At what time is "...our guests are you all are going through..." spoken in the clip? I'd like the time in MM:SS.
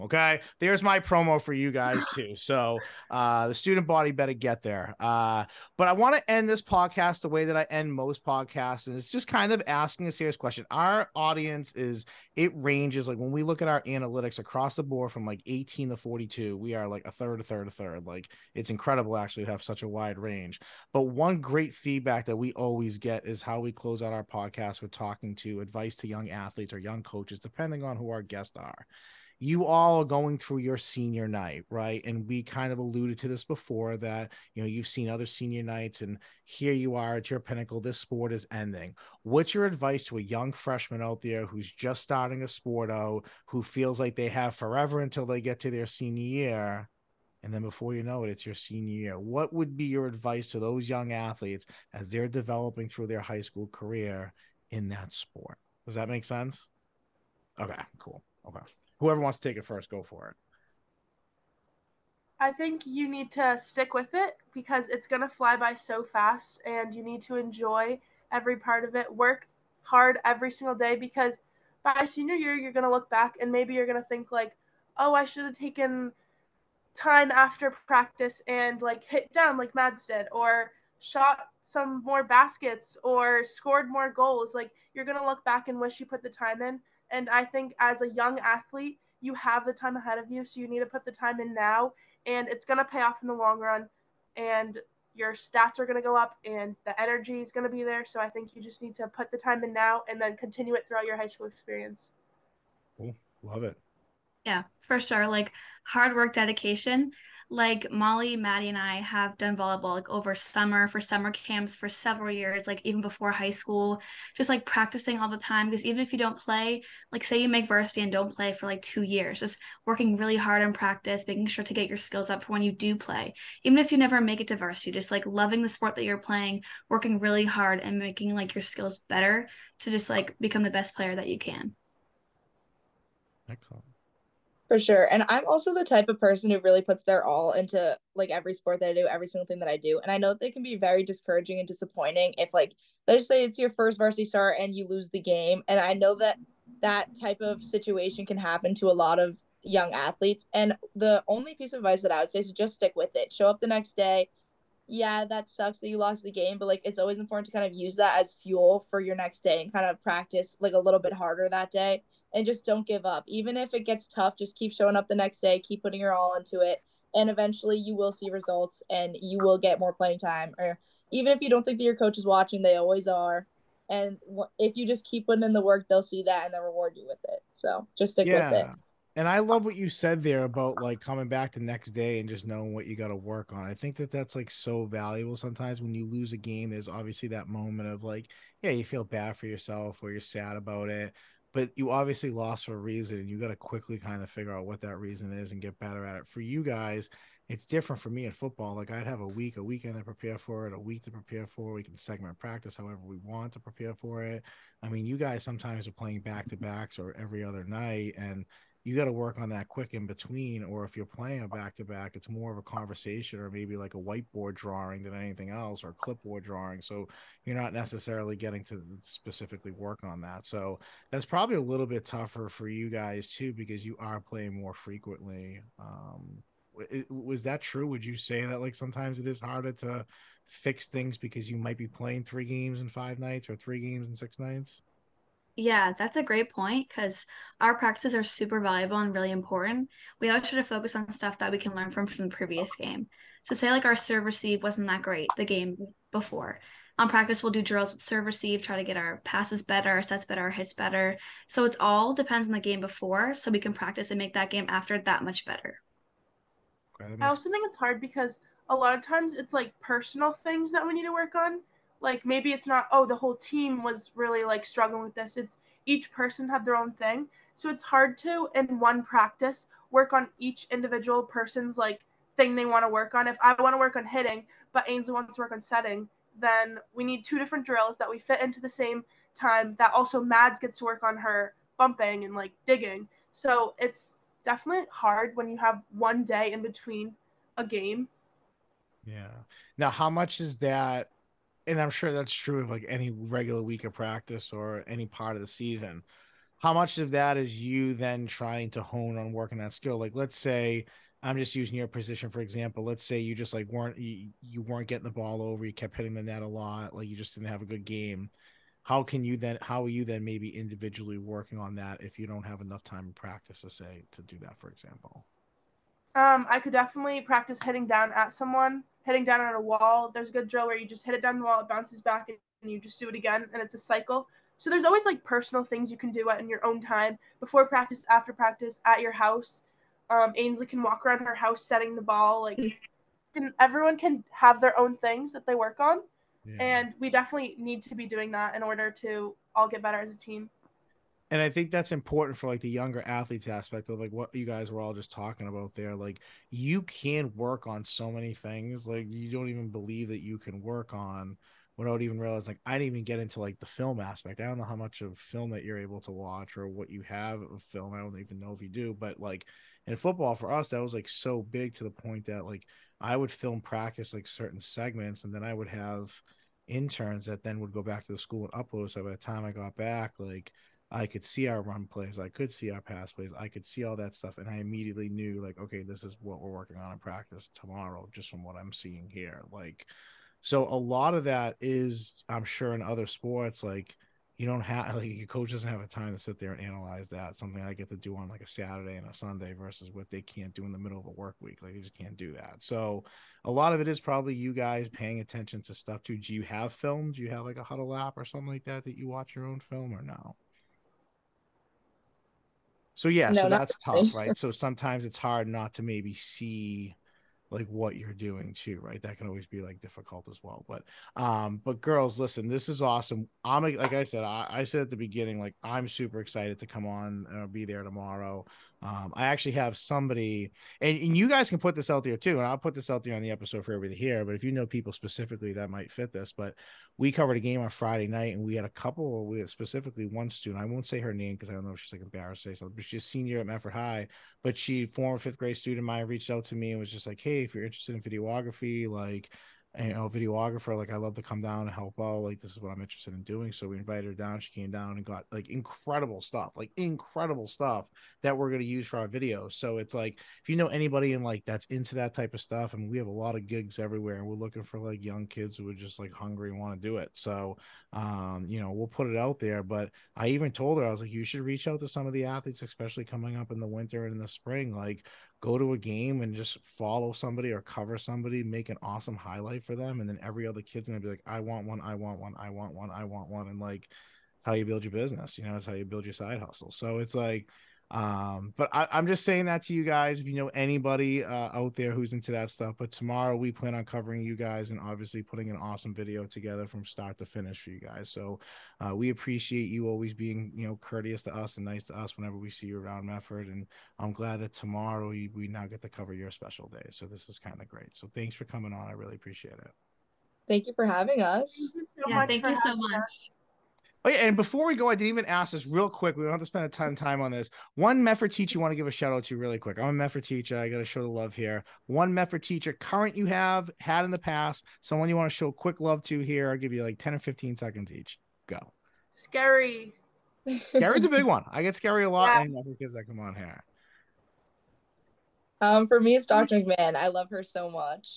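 00:28.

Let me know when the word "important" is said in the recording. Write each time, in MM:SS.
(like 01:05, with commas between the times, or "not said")
02:37, 03:59, 05:41.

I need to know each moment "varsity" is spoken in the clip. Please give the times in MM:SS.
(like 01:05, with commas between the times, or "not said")
01:57, 02:04, 02:23.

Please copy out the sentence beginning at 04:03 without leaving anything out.
So, say like our serve receive wasn't that great the game before.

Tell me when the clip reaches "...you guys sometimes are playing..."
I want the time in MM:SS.
03:25.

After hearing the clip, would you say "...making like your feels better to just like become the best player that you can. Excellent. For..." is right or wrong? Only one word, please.
wrong.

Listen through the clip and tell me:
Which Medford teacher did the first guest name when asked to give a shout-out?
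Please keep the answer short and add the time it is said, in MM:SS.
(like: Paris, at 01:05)
Dr. McMahon, at 08:46.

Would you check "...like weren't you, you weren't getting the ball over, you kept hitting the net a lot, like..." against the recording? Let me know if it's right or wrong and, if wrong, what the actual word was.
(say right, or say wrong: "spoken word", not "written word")
right.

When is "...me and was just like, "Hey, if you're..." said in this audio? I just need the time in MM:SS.
07:16.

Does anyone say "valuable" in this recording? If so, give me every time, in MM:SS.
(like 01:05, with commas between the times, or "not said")
03:04, 03:58.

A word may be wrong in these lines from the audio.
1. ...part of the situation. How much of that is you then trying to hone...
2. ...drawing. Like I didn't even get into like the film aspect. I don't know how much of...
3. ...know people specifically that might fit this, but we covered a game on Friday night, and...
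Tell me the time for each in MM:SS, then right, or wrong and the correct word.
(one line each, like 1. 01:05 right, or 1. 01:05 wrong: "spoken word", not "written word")
1. 04:55 wrong: "season", not "situation"
2. 05:52 wrong: "realizing", not "drawing"
3. 07:04 right.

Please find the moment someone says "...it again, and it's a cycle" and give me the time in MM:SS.
05:23.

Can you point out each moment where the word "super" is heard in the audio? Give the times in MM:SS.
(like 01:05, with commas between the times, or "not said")
03:58, 06:55.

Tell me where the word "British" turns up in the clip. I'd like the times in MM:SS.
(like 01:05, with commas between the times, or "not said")
not said.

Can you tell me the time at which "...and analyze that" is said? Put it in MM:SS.
06:26.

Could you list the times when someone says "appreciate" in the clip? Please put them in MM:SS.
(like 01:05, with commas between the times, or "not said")
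08:09, 08:19.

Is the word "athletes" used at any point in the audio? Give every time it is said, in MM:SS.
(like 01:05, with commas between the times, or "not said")
00:26, 00:51, 01:28, 02:29, 05:43, 07:42.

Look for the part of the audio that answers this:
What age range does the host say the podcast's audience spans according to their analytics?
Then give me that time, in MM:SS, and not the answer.
00:15.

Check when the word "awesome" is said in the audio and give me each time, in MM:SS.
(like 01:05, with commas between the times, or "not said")
06:52, 07:48, 08:05.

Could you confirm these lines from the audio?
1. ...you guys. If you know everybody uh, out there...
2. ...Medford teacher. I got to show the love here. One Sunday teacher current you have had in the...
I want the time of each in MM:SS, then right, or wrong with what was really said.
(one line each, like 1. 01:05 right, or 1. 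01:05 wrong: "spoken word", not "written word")
1. 07:59 wrong: "anybody", not "everybody"
2. 08:29 wrong: "Medford", not "Sunday".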